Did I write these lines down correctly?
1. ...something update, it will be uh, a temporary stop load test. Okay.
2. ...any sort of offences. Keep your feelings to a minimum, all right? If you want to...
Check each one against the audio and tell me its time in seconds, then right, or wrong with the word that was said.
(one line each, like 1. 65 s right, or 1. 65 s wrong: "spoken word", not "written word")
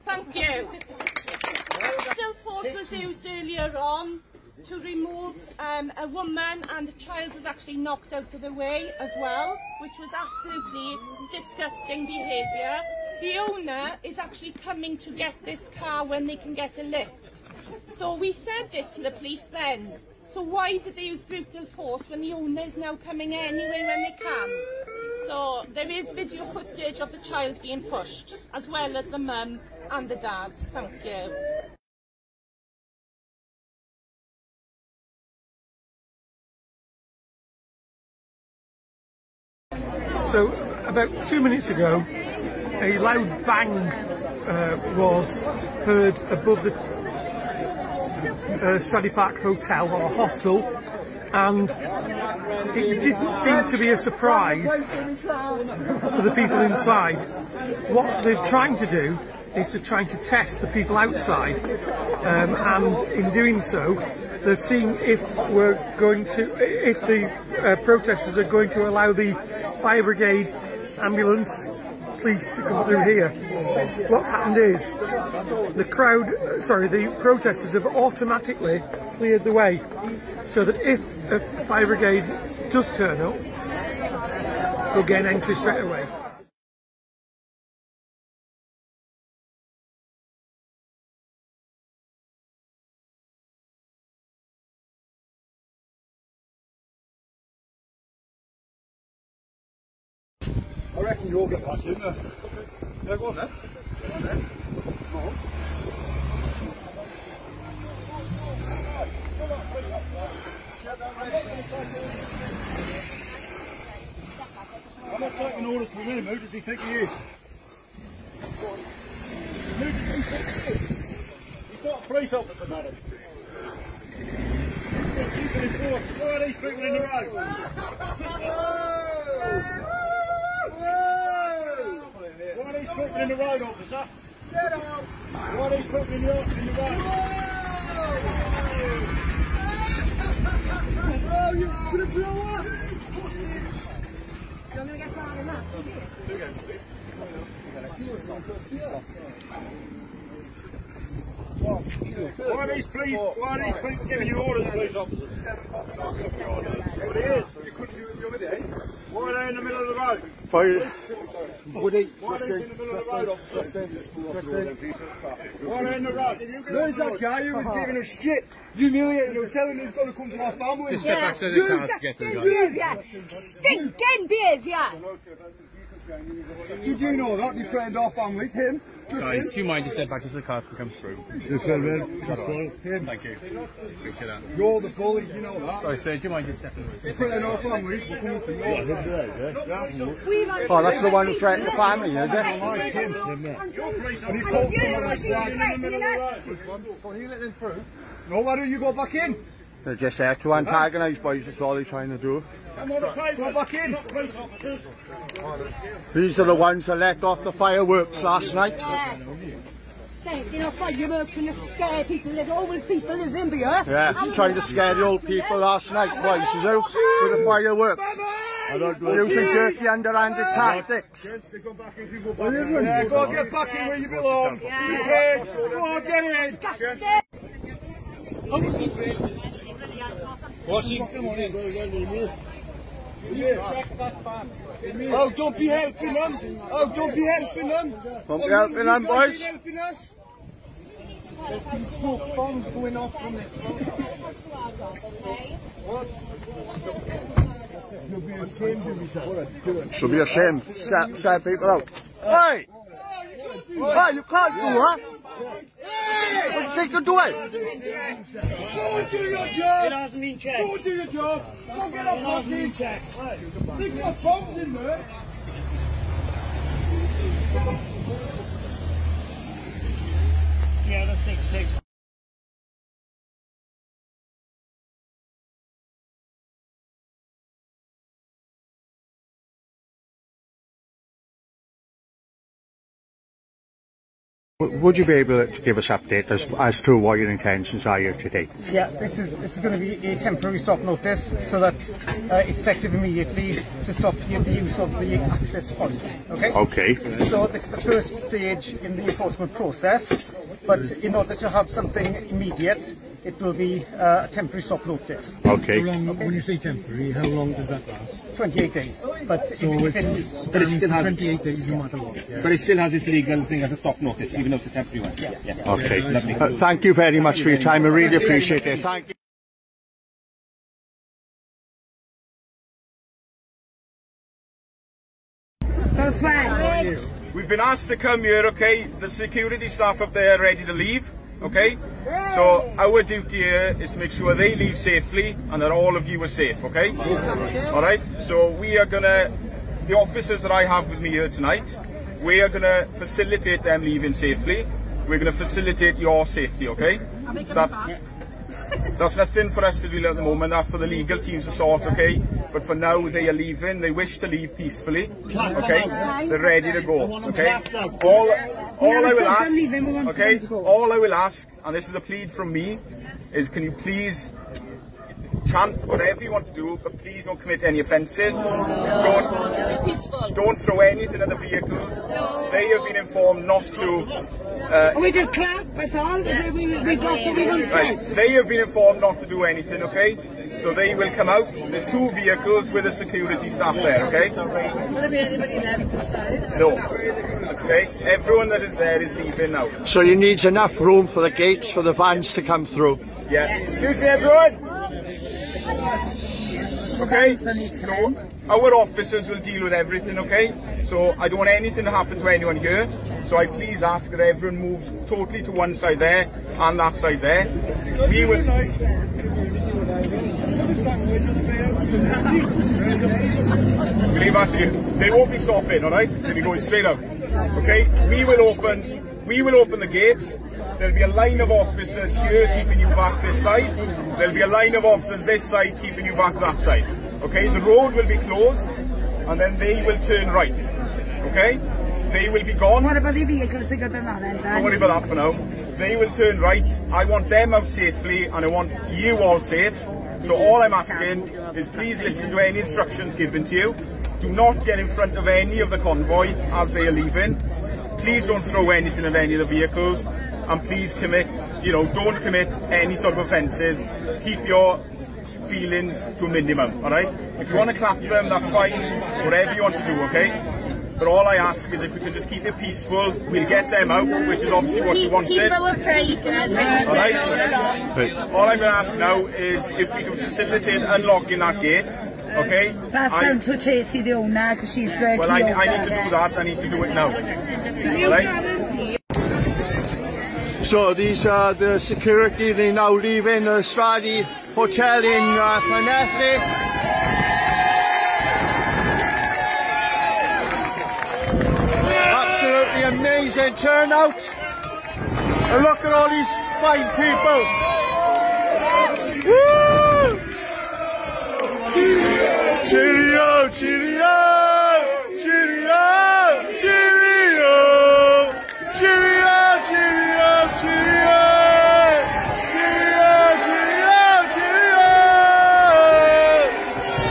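1. 301 s wrong: "immediate", not "update"
2. 452 s right.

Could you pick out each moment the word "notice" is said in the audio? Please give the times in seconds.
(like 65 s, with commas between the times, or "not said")
290 s, 313 s.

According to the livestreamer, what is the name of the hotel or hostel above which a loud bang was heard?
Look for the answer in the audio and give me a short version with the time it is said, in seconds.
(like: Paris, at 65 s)
Stradey Park Hotel, at 48 s.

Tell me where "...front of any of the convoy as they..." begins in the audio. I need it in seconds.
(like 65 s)
444 s.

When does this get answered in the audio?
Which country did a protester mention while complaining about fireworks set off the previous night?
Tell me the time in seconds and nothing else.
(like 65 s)
213 s.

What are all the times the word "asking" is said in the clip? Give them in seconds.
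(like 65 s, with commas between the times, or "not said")
440 s.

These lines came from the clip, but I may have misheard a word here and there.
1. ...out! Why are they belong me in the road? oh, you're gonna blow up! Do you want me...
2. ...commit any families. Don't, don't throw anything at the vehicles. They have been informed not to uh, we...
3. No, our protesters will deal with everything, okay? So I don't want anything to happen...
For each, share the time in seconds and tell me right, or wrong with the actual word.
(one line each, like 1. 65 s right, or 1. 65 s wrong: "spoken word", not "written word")
1. 134 s wrong: "putting", not "belong"
2. 367 s wrong: "offences", not "families"
3. 397 s wrong: "officers", not "protesters".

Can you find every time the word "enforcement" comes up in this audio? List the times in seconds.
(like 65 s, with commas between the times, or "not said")
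299 s.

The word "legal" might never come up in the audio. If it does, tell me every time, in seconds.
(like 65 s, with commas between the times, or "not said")
313 s, 350 s.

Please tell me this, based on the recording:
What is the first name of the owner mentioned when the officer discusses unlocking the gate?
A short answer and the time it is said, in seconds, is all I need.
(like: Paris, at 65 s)
Tracy, at 473 s.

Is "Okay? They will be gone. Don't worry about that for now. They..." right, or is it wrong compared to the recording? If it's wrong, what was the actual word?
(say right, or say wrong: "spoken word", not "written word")
right.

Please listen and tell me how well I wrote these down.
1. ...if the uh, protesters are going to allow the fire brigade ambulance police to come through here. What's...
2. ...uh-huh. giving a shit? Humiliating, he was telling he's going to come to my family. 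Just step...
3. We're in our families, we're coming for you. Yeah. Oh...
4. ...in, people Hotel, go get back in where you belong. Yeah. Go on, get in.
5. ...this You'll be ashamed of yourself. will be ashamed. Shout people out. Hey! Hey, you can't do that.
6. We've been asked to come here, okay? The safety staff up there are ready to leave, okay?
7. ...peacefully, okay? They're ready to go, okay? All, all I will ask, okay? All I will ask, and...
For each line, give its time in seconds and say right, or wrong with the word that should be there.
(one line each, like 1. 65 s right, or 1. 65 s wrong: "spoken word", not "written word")
1. 66 s right
2. 167 s right
3. 187 s right
4. 221 s wrong: "Yeah", not "Hotel"
5. 243 s right
6. 327 s wrong: "security", not "safety"
7. 354 s right.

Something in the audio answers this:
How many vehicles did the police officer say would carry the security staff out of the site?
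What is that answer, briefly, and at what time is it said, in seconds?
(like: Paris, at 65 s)
2, at 381 s.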